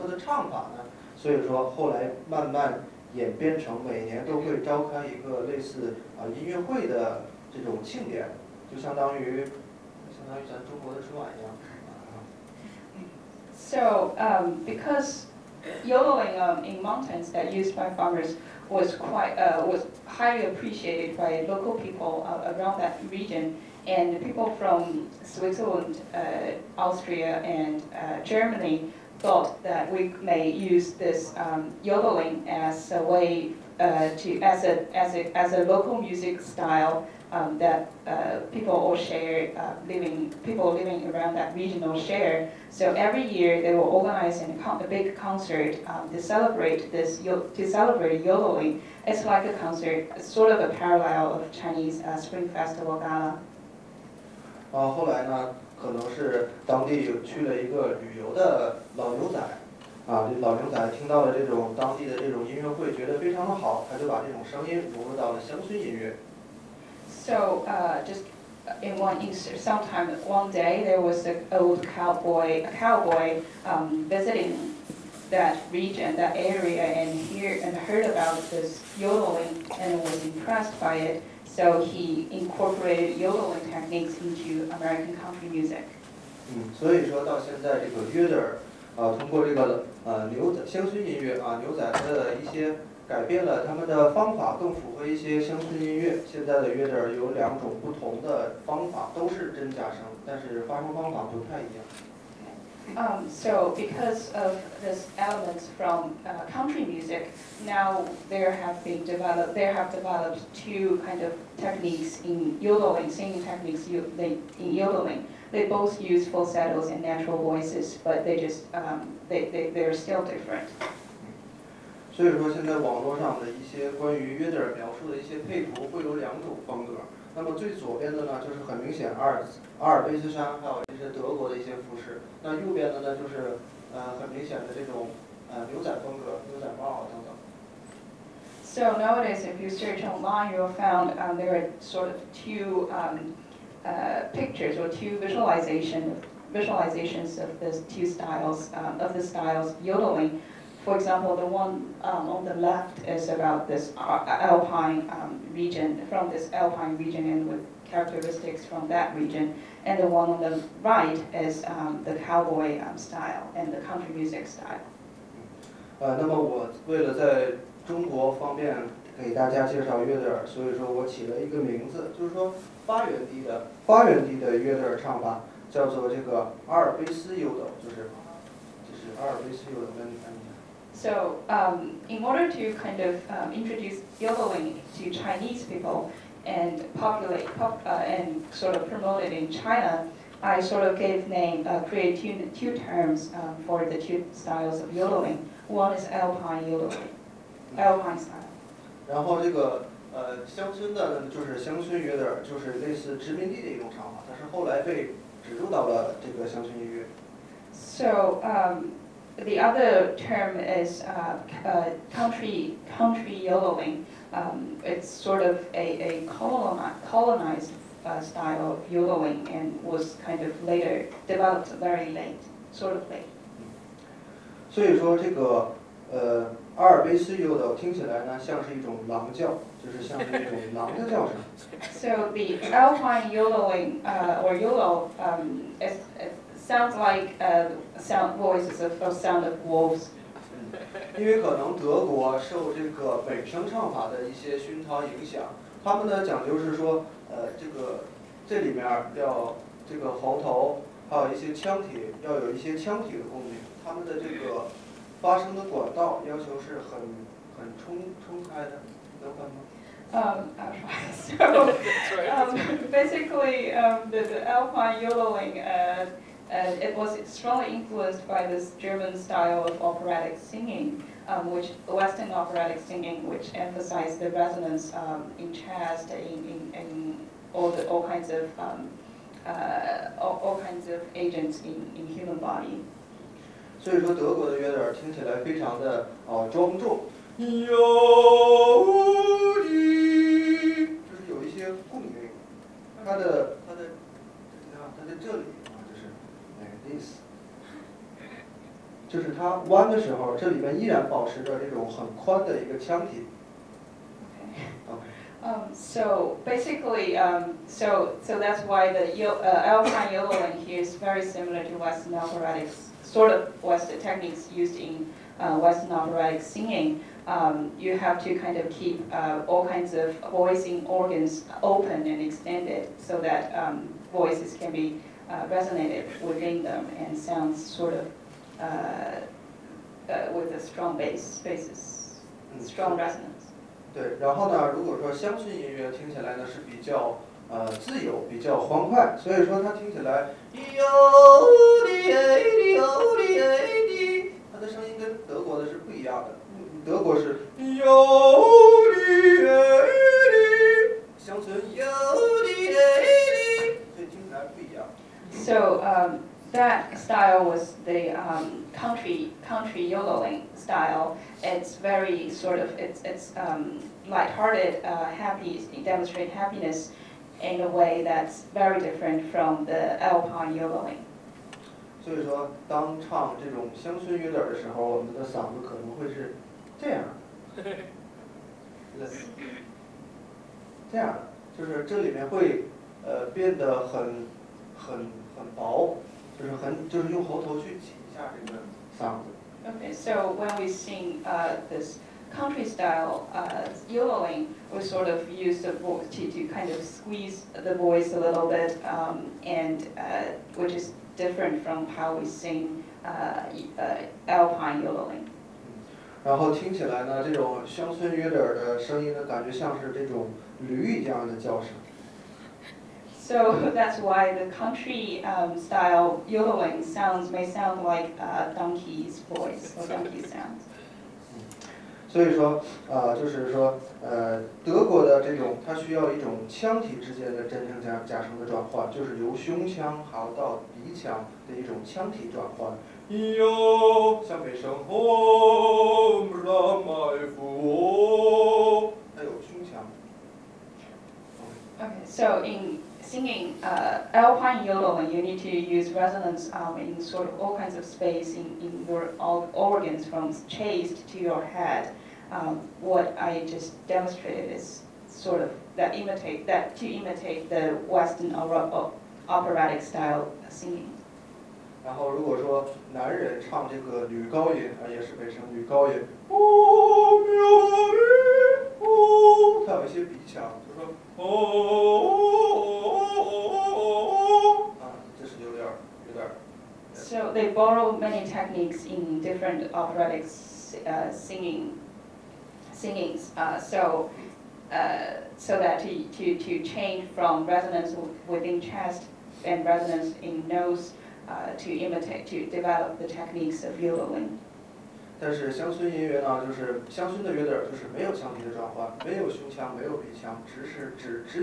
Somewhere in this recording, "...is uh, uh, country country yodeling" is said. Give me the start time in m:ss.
3:30.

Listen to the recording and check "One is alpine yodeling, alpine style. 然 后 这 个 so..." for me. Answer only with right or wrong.
right.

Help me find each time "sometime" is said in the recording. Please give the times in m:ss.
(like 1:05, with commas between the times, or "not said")
1:09.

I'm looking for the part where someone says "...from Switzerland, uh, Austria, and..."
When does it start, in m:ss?
0:24.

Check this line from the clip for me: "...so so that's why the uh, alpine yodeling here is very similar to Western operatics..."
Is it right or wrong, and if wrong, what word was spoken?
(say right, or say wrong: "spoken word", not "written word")
right.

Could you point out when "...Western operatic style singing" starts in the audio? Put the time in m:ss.
7:37.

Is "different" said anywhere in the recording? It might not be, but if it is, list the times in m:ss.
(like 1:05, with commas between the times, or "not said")
2:00, 6:08, 6:41, 7:59.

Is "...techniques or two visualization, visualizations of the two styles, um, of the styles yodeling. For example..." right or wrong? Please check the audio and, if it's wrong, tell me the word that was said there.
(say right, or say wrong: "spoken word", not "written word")
wrong: "pictures", not "techniques".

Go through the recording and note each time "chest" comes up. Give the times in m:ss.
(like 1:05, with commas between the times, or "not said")
4:35, 7:30, 8:08.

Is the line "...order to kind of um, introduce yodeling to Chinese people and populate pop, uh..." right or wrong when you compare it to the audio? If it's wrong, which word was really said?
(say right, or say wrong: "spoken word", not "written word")
right.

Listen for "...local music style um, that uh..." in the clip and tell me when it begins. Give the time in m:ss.
0:35.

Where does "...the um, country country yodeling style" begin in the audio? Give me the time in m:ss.
5:57.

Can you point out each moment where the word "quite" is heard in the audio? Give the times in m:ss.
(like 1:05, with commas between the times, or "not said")
0:18.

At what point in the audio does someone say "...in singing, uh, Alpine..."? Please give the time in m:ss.
7:22.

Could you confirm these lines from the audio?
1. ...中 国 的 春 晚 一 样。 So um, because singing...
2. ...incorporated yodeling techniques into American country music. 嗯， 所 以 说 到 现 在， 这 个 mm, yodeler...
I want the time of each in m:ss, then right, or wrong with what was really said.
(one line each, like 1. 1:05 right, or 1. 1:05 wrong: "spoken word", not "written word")
1. 0:10 wrong: "yodeling", not "singing"
2. 1:22 right.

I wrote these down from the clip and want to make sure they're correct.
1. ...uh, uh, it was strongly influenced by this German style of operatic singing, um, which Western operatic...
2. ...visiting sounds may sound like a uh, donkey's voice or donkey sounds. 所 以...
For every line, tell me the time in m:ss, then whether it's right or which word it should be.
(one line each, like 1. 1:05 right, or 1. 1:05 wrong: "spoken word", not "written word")
1. 4:25 right
2. 6:56 wrong: "yodeling", not "visiting".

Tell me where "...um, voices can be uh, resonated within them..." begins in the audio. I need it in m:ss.
5:23.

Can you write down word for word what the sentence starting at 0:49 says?
It's like a concert, sort of a parallel of Chinese uh, Spring Festival Gala.